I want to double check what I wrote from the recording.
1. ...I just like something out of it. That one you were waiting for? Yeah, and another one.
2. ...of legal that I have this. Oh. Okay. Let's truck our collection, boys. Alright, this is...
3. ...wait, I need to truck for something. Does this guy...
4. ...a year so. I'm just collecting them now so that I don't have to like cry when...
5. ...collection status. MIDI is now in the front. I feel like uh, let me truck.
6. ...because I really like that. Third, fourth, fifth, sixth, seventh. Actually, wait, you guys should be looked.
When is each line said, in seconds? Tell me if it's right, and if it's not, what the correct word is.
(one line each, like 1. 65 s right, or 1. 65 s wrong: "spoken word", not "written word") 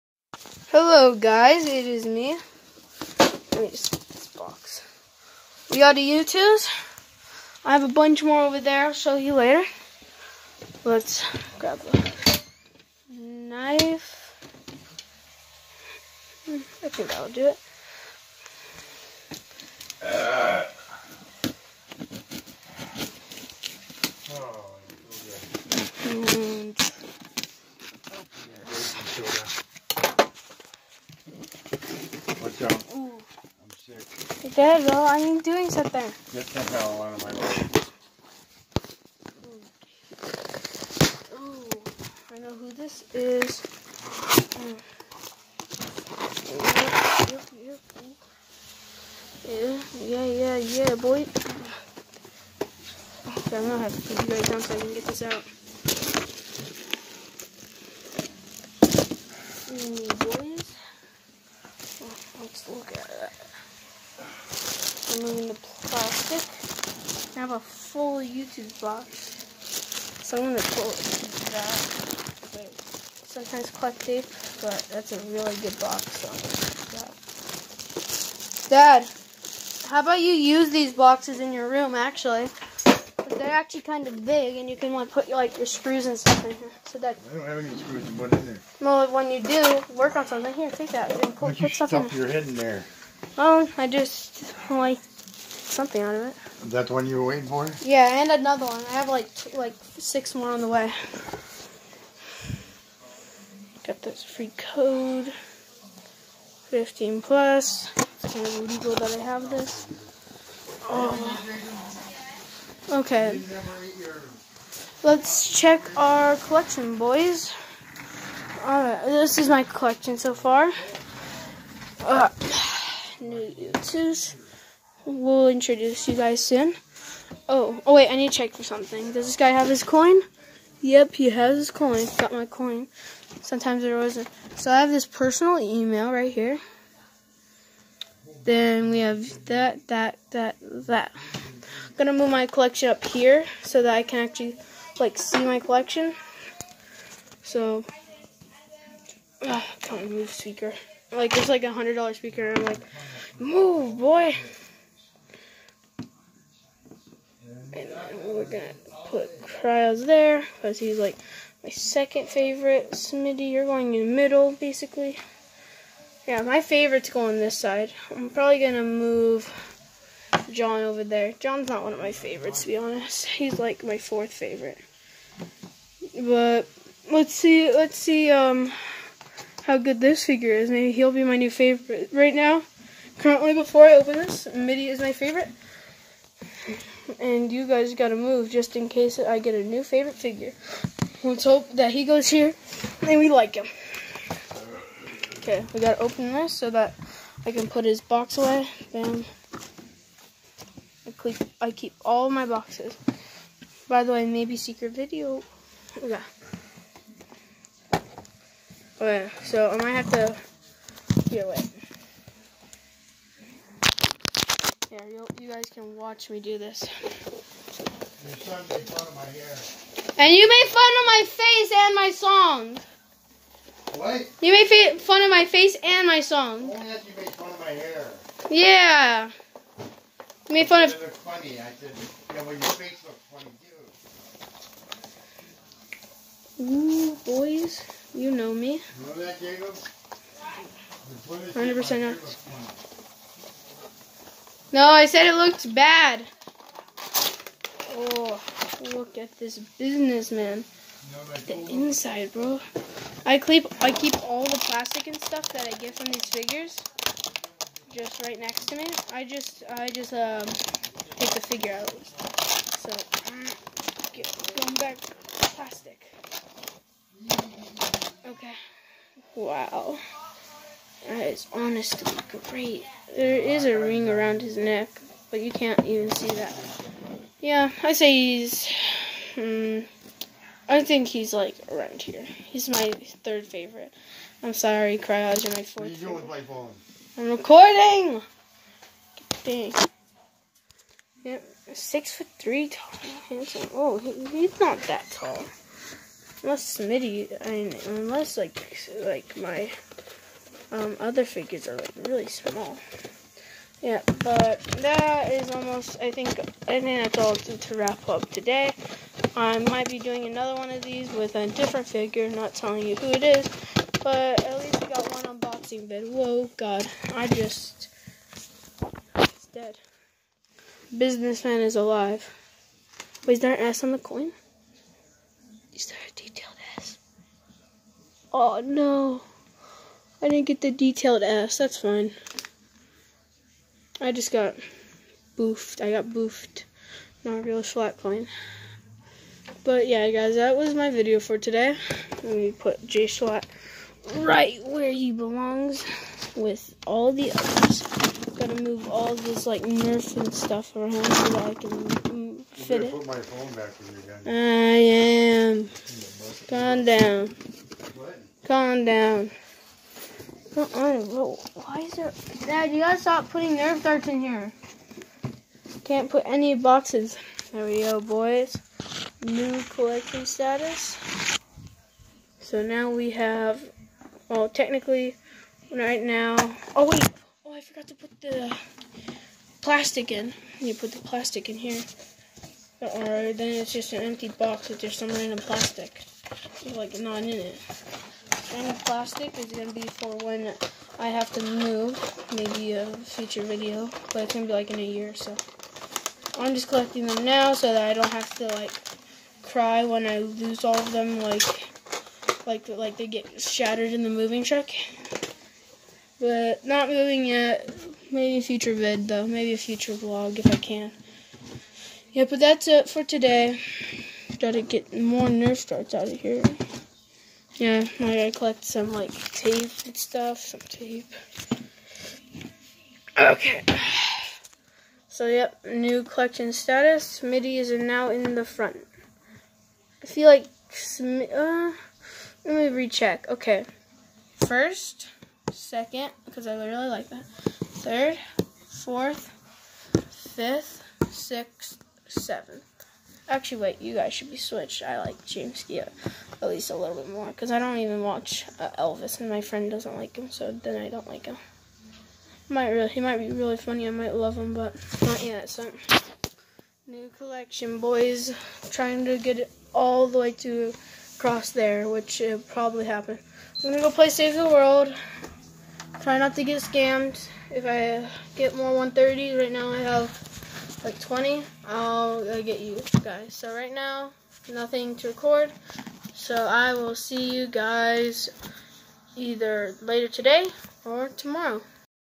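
1. 93 s right
2. 108 s wrong: "check", not "truck"
3. 127 s wrong: "check", not "truck"
4. 394 s right
5. 426 s wrong: "recheck", not "truck"
6. 436 s wrong: "switched", not "looked".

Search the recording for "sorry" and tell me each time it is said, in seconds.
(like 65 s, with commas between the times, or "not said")
284 s.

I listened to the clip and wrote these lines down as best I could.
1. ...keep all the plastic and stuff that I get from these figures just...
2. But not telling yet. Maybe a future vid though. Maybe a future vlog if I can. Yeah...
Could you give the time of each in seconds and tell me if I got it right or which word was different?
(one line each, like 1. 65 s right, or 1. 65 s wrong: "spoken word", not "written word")
1. 253 s right
2. 406 s wrong: "moving", not "telling".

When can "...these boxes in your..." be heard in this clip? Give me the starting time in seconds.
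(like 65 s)
80 s.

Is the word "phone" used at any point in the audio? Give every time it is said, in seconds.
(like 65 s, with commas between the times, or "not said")
286 s, 353 s.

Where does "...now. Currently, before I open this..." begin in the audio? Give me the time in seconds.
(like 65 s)
182 s.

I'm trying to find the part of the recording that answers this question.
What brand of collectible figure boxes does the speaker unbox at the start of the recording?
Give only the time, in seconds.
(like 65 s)
5 s.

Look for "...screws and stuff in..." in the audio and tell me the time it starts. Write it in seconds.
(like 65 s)
85 s.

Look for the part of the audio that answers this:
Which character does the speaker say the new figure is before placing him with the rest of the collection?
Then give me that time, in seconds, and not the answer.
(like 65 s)
342 s.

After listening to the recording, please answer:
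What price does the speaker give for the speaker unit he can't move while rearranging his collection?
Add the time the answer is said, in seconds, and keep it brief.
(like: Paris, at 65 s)
$100, at 151 s.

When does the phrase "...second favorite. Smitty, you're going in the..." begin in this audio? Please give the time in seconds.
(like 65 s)
161 s.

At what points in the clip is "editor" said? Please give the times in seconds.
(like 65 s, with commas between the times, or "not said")
not said.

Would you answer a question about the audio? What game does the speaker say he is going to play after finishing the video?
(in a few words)
Save the World.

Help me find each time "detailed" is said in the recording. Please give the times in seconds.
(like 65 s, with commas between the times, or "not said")
326 s, 330 s.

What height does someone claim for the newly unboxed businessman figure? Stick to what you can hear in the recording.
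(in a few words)
6 foot 3.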